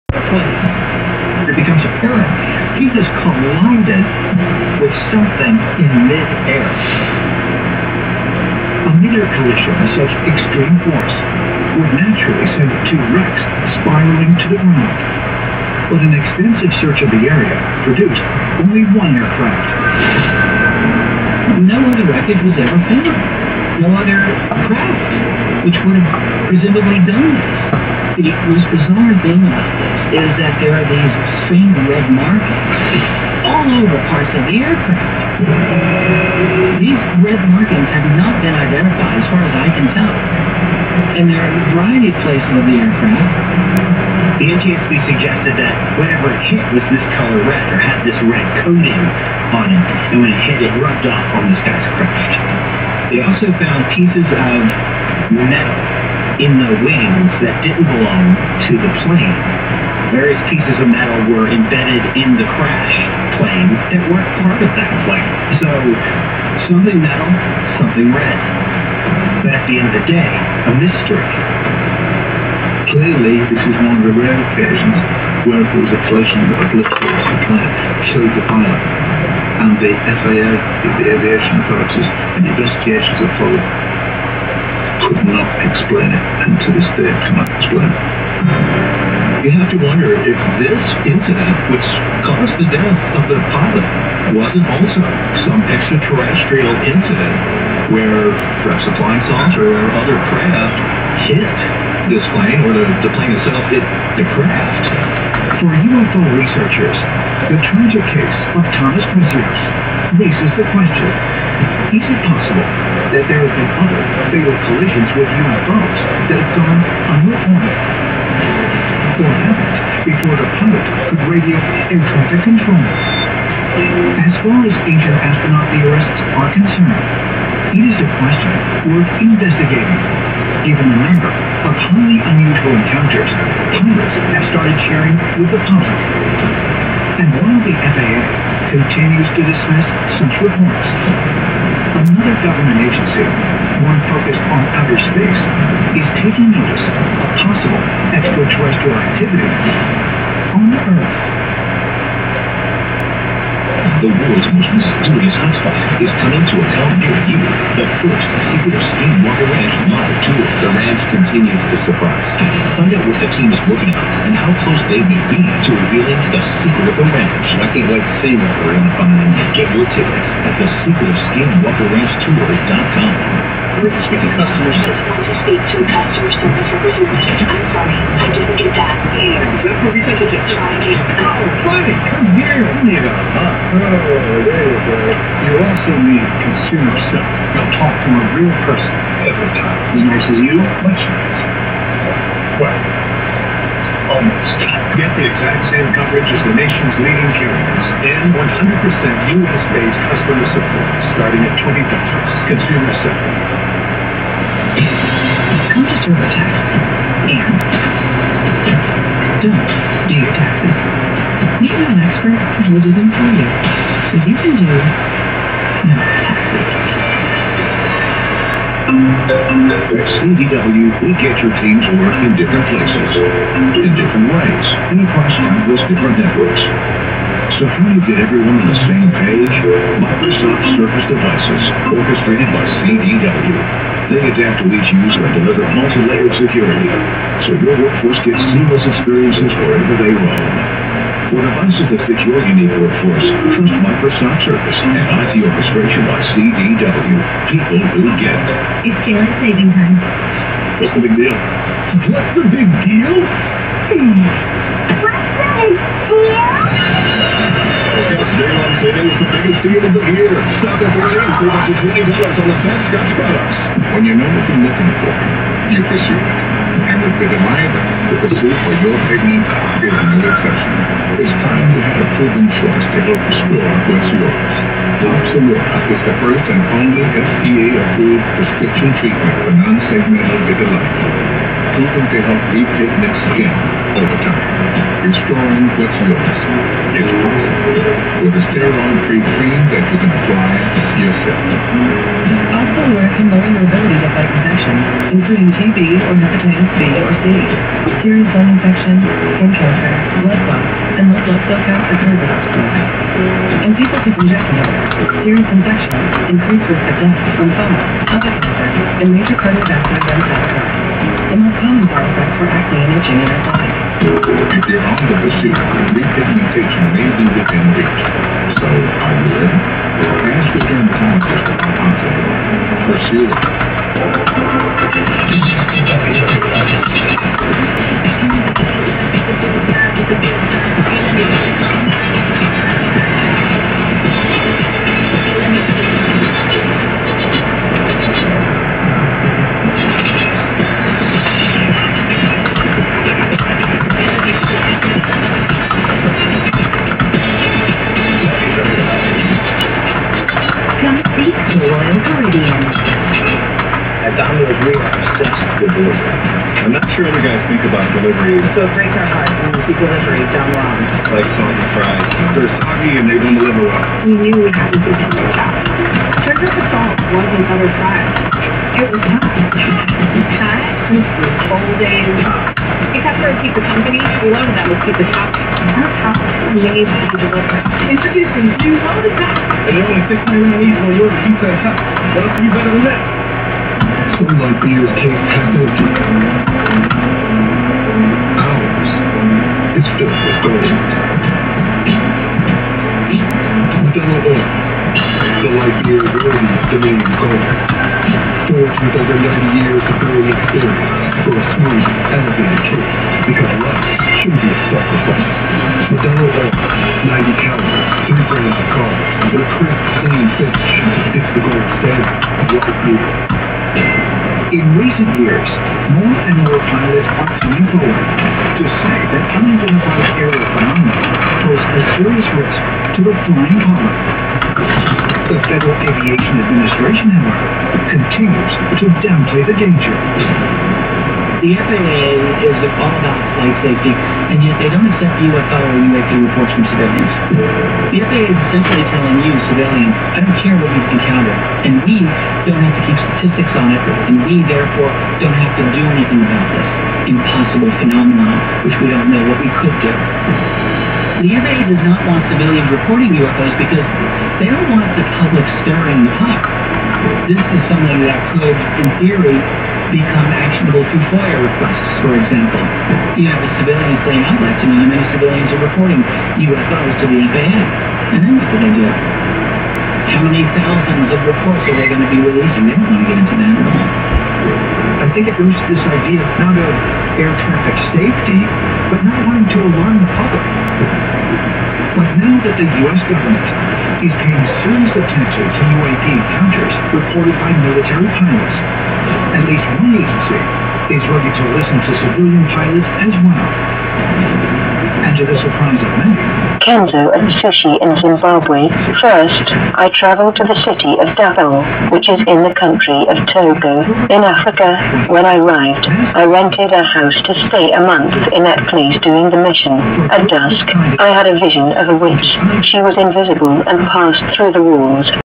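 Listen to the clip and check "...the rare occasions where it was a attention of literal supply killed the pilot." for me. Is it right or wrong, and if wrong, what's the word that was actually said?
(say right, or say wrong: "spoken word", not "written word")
wrong: "collision", not "attention".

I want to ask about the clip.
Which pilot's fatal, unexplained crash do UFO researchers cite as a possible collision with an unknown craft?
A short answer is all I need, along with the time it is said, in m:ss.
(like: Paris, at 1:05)
Thomas Mazuris, at 1:48.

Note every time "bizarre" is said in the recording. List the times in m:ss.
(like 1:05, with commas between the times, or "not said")
0:28.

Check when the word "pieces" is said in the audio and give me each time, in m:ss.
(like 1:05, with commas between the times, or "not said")
0:53, 1:00.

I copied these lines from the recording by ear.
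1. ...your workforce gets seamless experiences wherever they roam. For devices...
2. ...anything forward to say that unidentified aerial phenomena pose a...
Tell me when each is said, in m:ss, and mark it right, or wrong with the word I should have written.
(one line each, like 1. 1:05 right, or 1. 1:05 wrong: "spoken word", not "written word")
1. 3:57 right
2. 6:57 wrong: "coming", not "anything".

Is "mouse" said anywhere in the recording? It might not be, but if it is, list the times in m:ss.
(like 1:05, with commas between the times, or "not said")
not said.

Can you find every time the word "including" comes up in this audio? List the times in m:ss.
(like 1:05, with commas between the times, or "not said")
4:55.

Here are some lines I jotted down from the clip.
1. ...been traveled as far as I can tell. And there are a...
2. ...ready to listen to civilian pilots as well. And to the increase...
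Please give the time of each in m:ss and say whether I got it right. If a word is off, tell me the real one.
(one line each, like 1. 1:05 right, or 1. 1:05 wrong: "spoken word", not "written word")
1. 0:38 wrong: "identified", not "traveled"
2. 8:11 wrong: "surprise", not "increase".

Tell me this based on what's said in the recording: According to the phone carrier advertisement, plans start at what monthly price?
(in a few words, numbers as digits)
$20.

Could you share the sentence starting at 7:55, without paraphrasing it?
I think it goes this idea not of air traffic safety, but not wanting to alarm the public.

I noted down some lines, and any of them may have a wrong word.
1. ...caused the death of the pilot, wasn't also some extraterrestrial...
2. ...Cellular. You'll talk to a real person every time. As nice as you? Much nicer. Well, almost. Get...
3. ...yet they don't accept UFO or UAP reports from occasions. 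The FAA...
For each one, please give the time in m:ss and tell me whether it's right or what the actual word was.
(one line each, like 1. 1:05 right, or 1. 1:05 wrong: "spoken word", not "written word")
1. 1:32 right
2. 3:07 right
3. 7:14 wrong: "civilians", not "occasions".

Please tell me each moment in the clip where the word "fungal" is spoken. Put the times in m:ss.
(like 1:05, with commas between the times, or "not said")
5:07.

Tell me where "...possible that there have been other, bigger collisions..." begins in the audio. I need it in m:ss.
1:52.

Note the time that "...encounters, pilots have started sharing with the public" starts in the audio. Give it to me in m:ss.
2:12.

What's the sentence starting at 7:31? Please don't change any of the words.
The FAA does not want civilians reporting UFOs because they don't want the public stirring the pot.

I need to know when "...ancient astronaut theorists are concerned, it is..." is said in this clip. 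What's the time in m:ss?
2:04.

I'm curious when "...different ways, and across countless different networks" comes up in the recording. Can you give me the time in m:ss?
3:43.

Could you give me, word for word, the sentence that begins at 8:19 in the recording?
First, I traveled to the city of Davao, which is in the country of Togo.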